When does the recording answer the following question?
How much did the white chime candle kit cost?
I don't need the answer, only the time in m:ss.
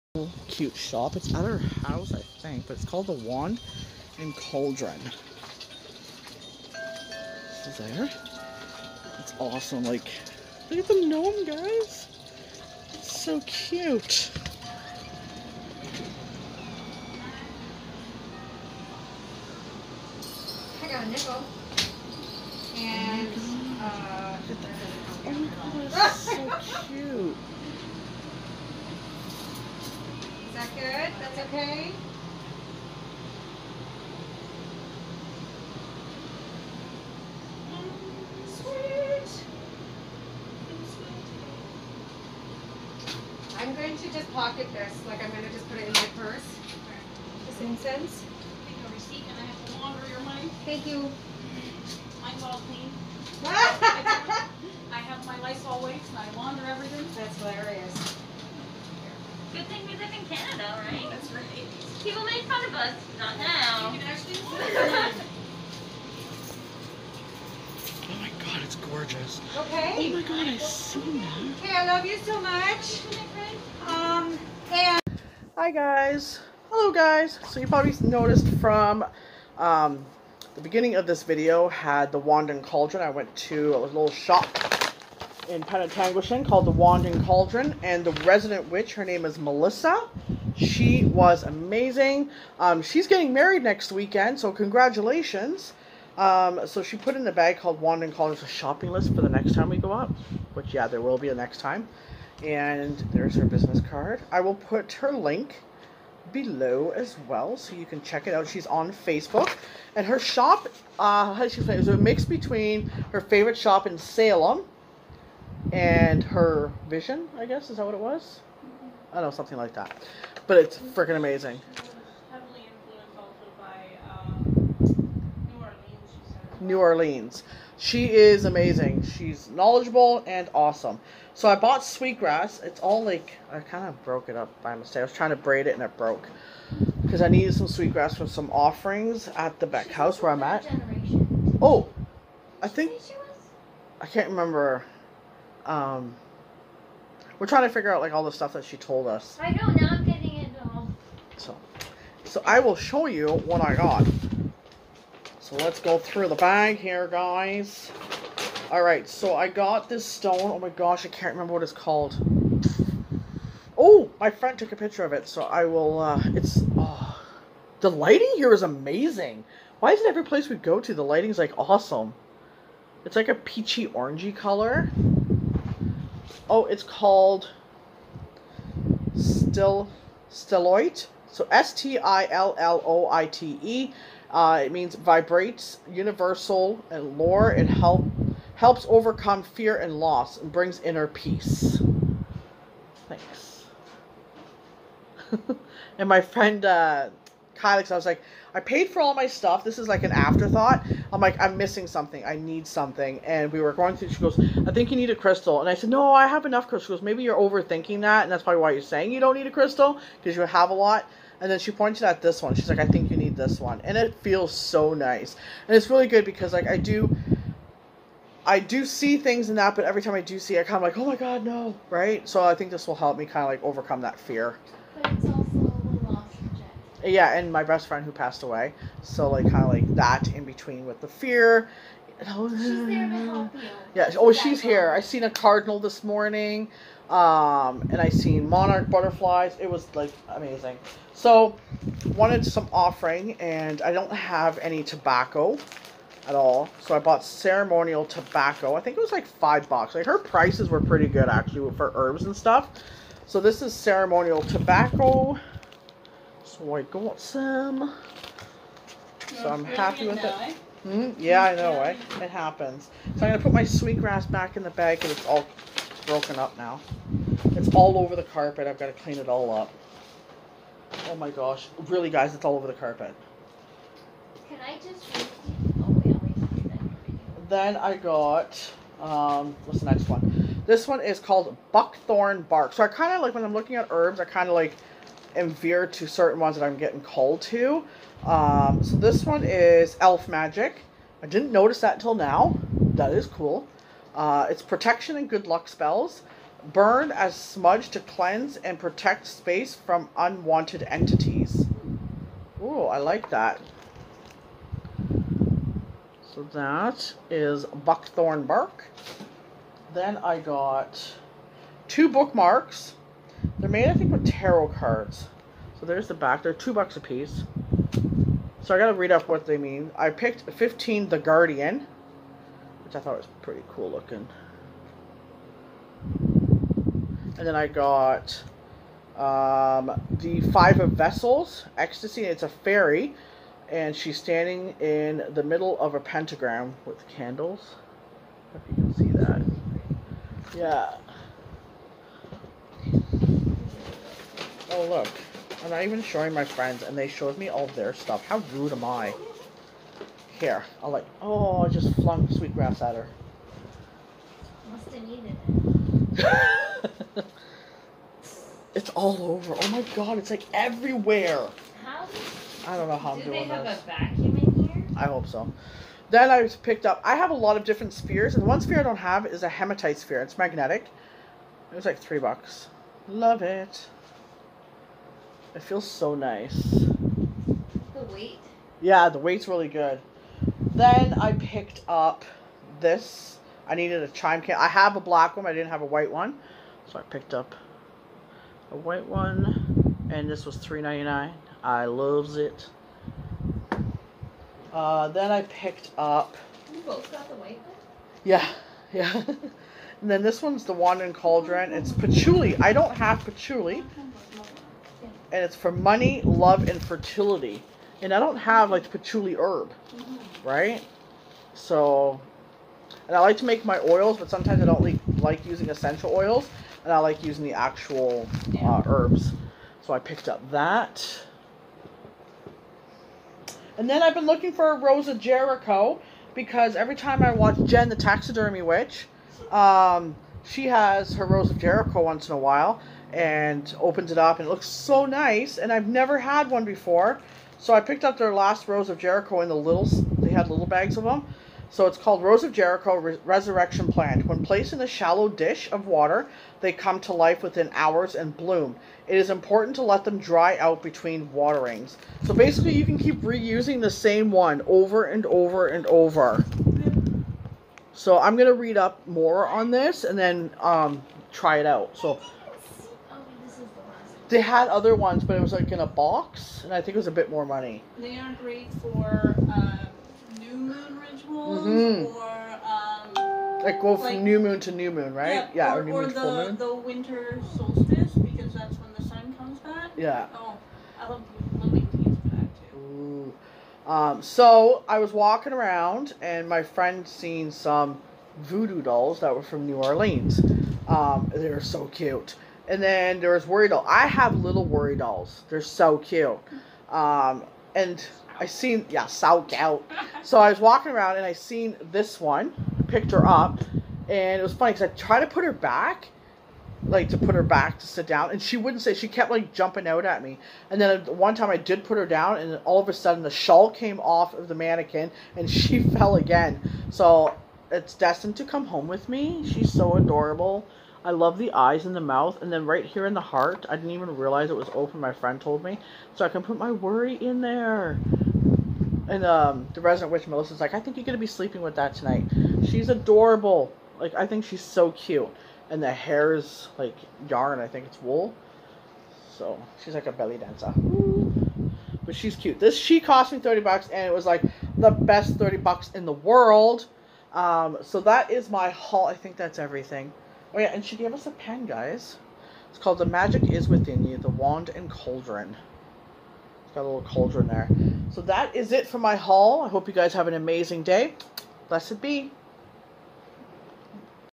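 6:30.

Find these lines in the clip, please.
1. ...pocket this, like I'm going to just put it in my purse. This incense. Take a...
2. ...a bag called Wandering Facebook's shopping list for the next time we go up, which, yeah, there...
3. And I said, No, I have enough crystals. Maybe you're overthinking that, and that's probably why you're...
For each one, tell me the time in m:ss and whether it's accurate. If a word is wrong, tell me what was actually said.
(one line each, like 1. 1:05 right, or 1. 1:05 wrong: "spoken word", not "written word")
1. 0:44 right
2. 1:37 wrong: "Cauldron", not "Facebook"
3. 3:25 right.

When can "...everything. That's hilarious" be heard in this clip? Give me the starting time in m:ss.
0:56.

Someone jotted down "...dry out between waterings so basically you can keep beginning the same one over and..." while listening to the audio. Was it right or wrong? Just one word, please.
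wrong.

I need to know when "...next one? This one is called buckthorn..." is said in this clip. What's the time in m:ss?
4:39.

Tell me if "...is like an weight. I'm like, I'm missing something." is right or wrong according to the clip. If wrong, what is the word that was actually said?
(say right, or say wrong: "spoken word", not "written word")
wrong: "afterthought", not "weight".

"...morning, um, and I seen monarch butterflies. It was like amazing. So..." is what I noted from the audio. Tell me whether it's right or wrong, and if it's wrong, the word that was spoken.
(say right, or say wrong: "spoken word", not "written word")
right.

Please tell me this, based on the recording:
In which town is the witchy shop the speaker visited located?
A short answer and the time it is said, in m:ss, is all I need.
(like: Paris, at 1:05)
Penetanguishene, at 1:25.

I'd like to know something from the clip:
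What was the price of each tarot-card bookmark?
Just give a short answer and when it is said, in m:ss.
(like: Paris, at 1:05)
$2, at 5:16.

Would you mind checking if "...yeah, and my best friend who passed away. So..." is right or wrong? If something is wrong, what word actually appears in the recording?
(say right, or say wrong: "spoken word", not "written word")
right.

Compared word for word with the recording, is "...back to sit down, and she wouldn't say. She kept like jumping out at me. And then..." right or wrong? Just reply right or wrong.
right.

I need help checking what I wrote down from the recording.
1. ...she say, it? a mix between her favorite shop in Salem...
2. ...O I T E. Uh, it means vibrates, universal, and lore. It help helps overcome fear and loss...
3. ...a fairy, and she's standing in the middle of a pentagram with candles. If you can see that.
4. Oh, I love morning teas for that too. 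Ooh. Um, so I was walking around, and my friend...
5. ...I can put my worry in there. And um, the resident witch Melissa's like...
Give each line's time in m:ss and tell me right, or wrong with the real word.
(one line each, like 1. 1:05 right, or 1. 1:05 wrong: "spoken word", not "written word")
1. 1:51 right
2. 3:02 right
3. 5:32 right
4. 8:00 wrong: "living", not "morning"
5. 8:46 right.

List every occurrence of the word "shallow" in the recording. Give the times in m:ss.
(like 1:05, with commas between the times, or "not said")
7:24.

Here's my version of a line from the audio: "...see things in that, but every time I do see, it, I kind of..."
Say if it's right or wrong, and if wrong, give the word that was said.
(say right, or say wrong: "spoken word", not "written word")
right.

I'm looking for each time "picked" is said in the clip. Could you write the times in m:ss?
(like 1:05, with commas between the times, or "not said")
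5:20, 6:06, 6:21, 6:27, 6:35, 6:59, 7:17, 8:22.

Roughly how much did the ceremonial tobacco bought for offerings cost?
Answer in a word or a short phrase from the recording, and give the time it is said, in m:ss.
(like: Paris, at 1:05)
$5, at 4:09.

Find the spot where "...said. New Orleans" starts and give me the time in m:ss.
2:06.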